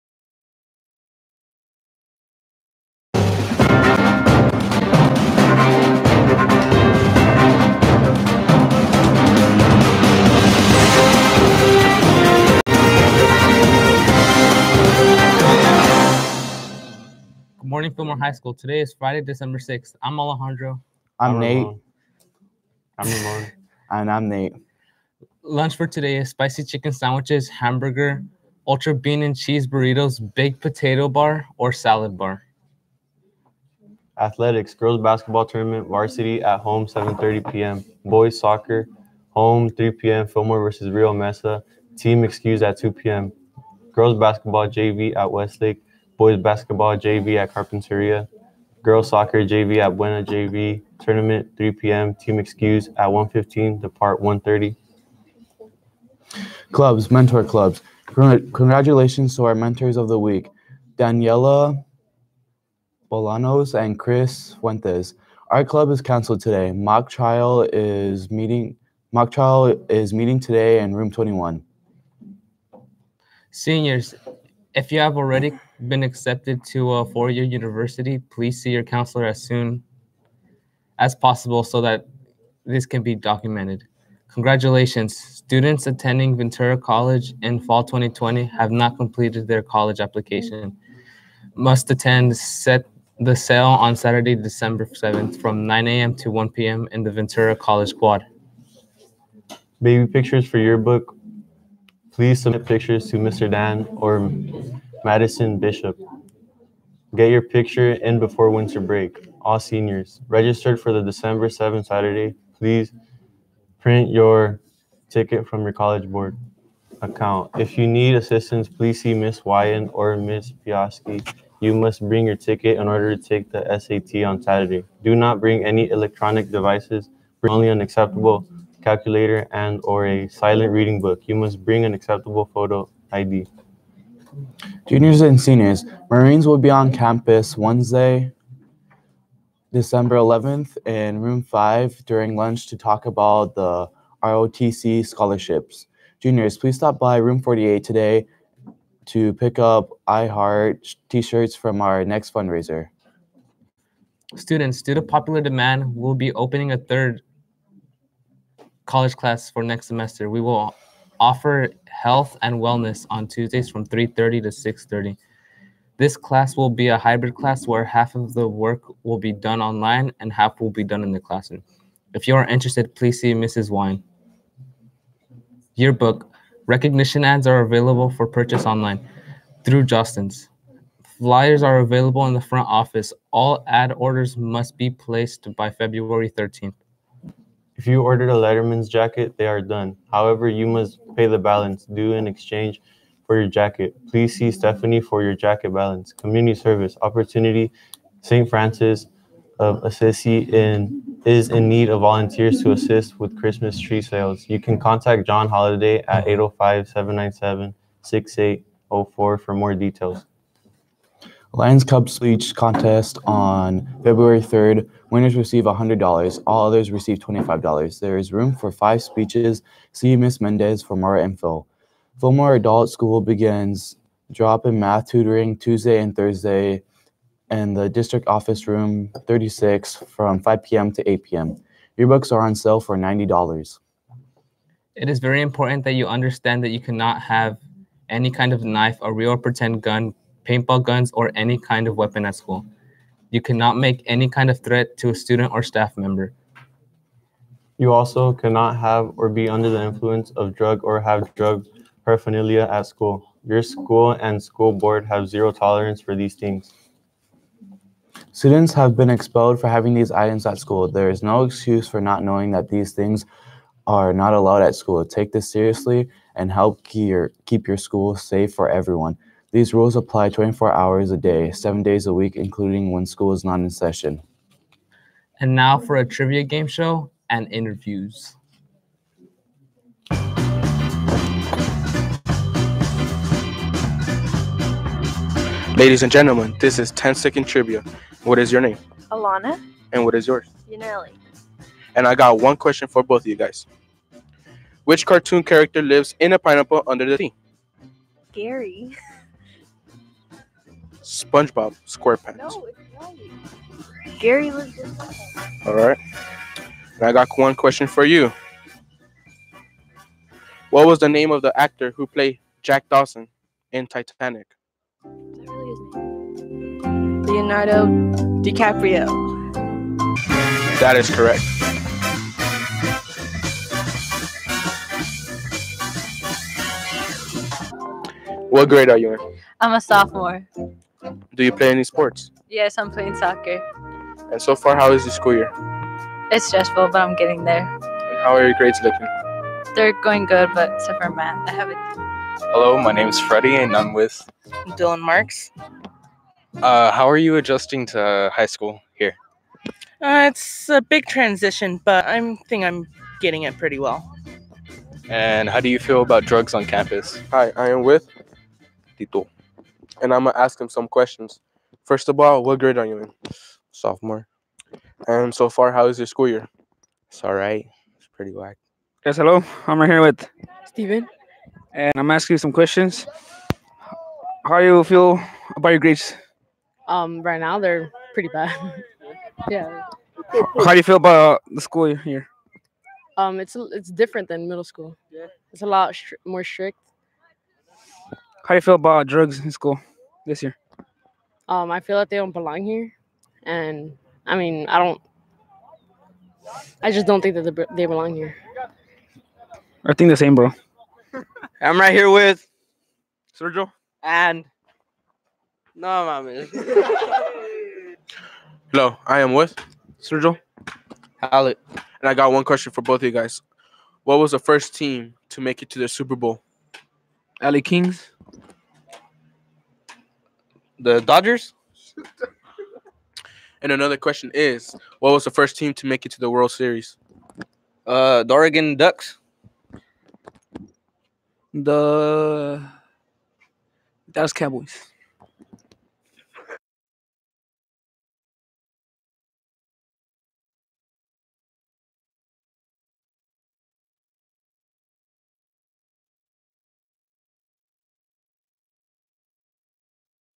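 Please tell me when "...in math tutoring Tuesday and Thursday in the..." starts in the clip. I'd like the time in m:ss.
3:44.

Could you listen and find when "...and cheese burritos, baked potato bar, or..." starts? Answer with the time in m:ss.
0:29.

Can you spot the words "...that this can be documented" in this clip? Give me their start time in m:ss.
1:21.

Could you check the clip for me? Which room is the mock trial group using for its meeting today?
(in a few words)
Room 21.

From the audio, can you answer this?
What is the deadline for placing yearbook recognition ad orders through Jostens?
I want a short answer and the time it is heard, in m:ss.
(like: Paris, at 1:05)
February 13th, at 3:05.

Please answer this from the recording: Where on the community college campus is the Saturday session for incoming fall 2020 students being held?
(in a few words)
Ventura College Quad.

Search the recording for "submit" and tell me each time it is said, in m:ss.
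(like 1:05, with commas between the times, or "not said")
1:42.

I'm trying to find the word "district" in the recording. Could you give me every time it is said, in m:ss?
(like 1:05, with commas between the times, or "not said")
3:47.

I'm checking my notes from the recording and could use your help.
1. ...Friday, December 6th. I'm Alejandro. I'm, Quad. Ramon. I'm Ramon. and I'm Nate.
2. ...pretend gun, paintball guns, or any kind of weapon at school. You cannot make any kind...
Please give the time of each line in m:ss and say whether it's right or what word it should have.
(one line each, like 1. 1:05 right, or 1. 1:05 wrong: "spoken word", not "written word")
1. 0:18 wrong: "Nate", not "Quad"
2. 3:59 right.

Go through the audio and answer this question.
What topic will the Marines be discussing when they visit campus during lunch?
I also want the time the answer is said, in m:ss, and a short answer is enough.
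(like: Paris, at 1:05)
ROTC scholarships, at 2:24.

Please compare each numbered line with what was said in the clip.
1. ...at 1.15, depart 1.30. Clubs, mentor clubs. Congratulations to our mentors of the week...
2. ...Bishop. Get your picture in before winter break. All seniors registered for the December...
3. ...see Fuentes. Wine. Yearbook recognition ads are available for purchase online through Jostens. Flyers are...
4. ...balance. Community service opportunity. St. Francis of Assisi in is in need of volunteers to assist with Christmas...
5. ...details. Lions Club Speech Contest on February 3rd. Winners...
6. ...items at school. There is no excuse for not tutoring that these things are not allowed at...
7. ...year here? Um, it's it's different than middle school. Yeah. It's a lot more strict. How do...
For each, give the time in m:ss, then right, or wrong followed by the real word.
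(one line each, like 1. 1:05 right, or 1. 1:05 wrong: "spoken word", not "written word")
1. 0:52 right
2. 1:45 right
3. 2:53 wrong: "Mrs", not "Fuentes"
4. 3:15 right
5. 3:29 right
6. 4:20 wrong: "knowing", not "tutoring"
7. 6:21 right.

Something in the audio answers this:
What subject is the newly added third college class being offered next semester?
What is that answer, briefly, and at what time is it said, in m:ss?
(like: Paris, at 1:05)
Health and wellness, at 2:41.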